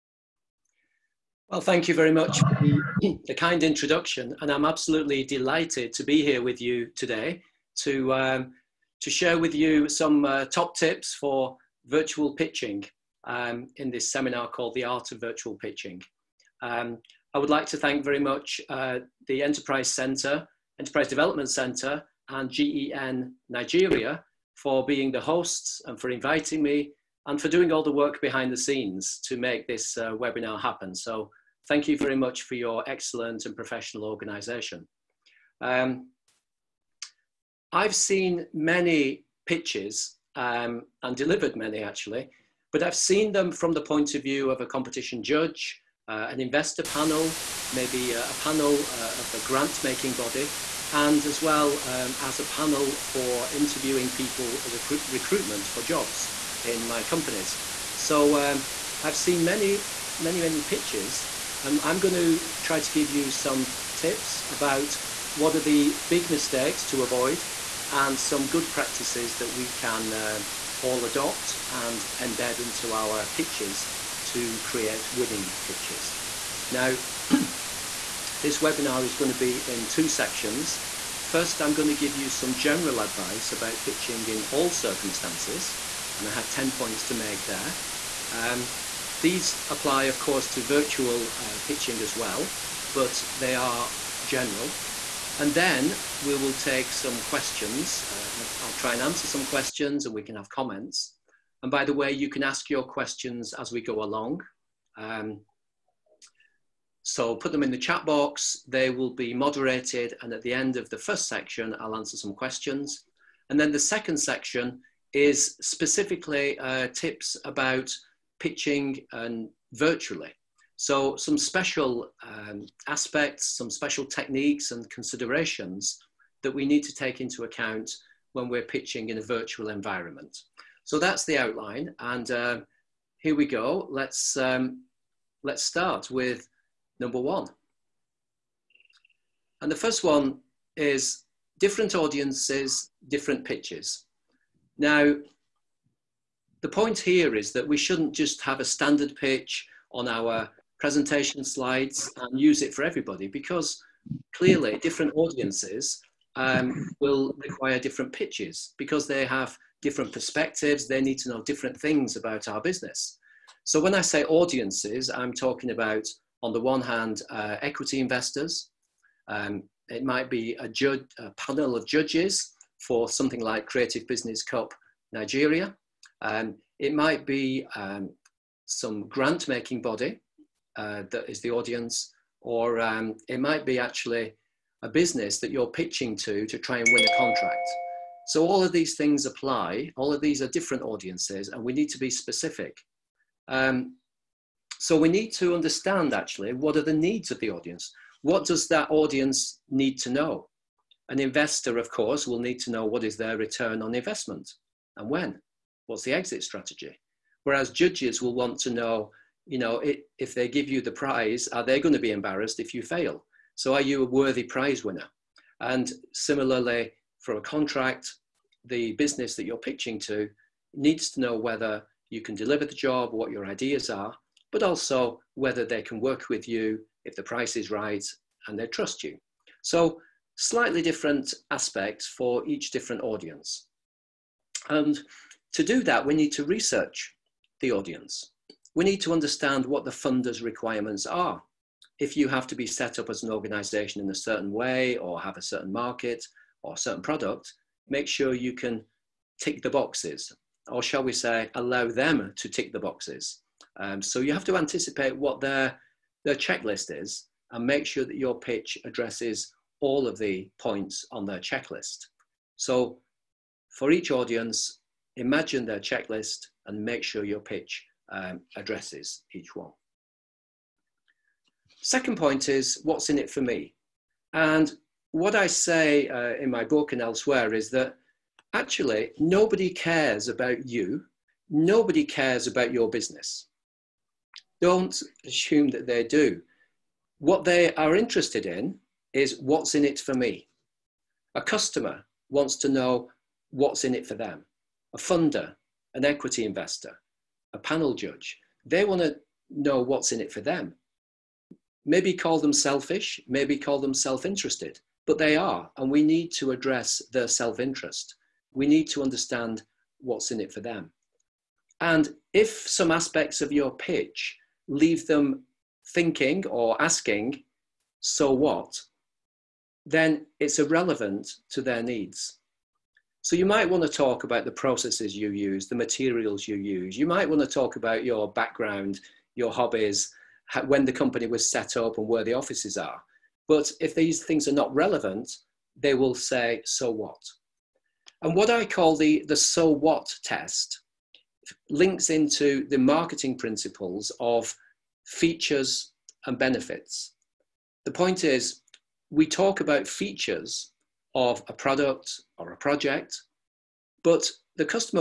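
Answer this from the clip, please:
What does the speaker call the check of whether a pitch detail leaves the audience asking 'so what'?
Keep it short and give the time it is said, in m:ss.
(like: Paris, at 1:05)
The so what test, at 5:39.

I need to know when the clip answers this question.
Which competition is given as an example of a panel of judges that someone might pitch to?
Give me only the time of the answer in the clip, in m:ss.
2:53.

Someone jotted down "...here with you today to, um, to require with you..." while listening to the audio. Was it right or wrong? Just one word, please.
wrong.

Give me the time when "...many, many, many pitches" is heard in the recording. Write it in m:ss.
0:59.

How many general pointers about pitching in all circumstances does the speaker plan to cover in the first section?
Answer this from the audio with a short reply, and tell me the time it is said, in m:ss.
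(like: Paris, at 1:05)
10, at 1:26.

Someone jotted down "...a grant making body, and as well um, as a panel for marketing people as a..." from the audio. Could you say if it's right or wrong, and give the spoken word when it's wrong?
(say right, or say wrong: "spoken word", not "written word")
wrong: "interviewing", not "marketing".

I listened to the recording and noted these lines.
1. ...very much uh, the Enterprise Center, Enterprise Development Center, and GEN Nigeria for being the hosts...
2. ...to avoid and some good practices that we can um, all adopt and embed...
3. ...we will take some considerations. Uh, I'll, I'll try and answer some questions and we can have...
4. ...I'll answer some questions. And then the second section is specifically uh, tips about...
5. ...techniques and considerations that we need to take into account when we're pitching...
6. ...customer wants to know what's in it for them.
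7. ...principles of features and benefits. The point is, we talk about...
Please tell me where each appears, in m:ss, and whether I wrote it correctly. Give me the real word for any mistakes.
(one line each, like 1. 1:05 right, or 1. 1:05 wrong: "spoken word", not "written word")
1. 0:18 right
2. 1:06 right
3. 1:36 wrong: "questions", not "considerations"
4. 1:51 right
5. 2:04 right
6. 4:51 right
7. 5:43 right.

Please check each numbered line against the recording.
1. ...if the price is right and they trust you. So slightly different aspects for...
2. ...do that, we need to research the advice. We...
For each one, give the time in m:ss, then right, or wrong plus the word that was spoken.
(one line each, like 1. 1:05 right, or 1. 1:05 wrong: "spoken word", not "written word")
1. 3:47 right
2. 3:55 wrong: "audience", not "advice".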